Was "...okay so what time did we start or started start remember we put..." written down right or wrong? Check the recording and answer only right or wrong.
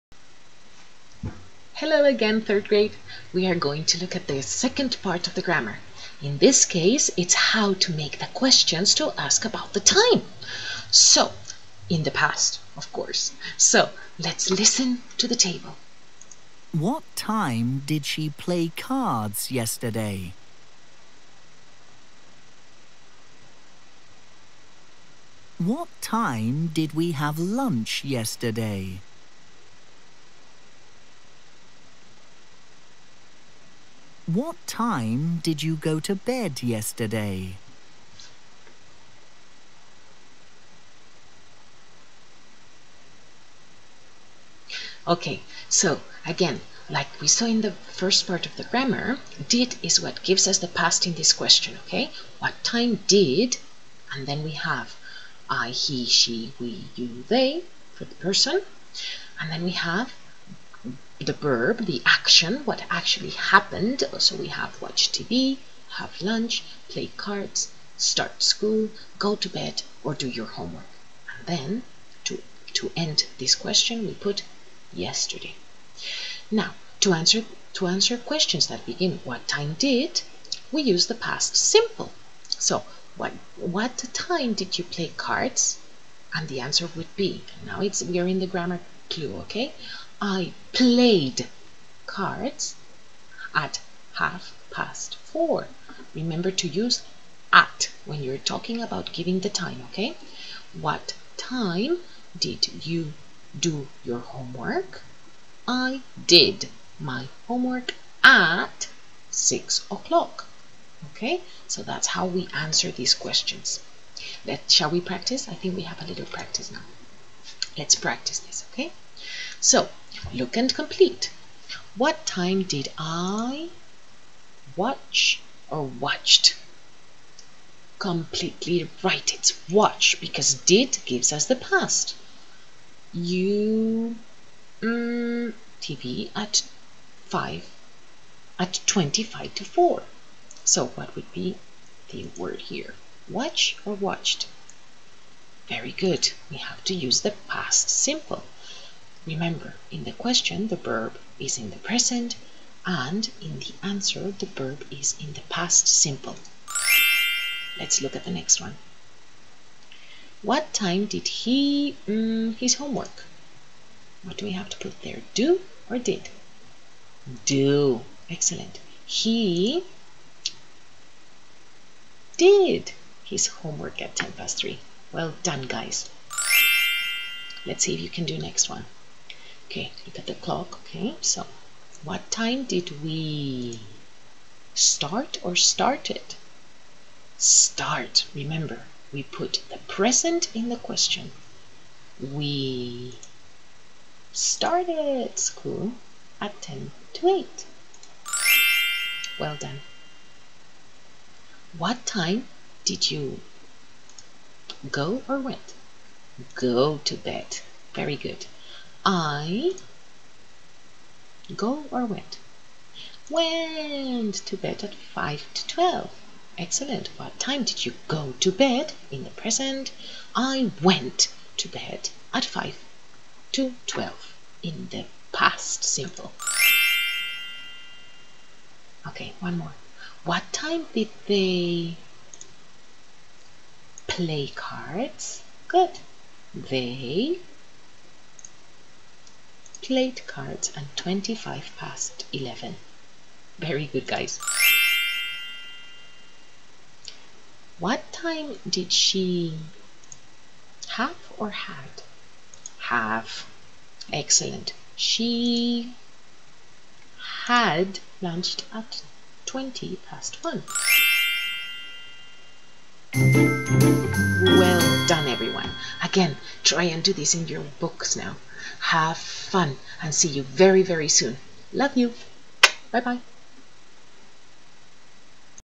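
right.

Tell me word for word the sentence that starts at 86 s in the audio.
And the answer would be, now it's, we are in the grammar clue, okay?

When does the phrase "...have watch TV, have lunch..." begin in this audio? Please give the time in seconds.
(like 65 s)
64 s.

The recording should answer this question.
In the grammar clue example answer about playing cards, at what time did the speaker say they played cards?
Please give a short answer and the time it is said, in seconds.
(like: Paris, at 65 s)
half past 4, at 94 s.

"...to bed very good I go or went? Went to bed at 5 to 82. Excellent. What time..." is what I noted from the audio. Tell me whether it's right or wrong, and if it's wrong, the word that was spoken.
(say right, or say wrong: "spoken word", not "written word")
wrong: "12", not "82".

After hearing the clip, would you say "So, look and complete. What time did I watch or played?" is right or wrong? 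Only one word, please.
wrong.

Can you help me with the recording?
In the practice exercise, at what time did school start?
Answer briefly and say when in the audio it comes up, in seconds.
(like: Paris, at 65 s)
10 to 8, at 196 s.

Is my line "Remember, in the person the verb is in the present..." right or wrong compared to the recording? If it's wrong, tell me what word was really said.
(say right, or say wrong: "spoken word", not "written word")
wrong: "question", not "person".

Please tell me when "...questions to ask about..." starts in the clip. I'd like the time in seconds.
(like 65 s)
8 s.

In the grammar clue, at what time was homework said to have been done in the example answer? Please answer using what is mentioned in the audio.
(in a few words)
6 o'clock.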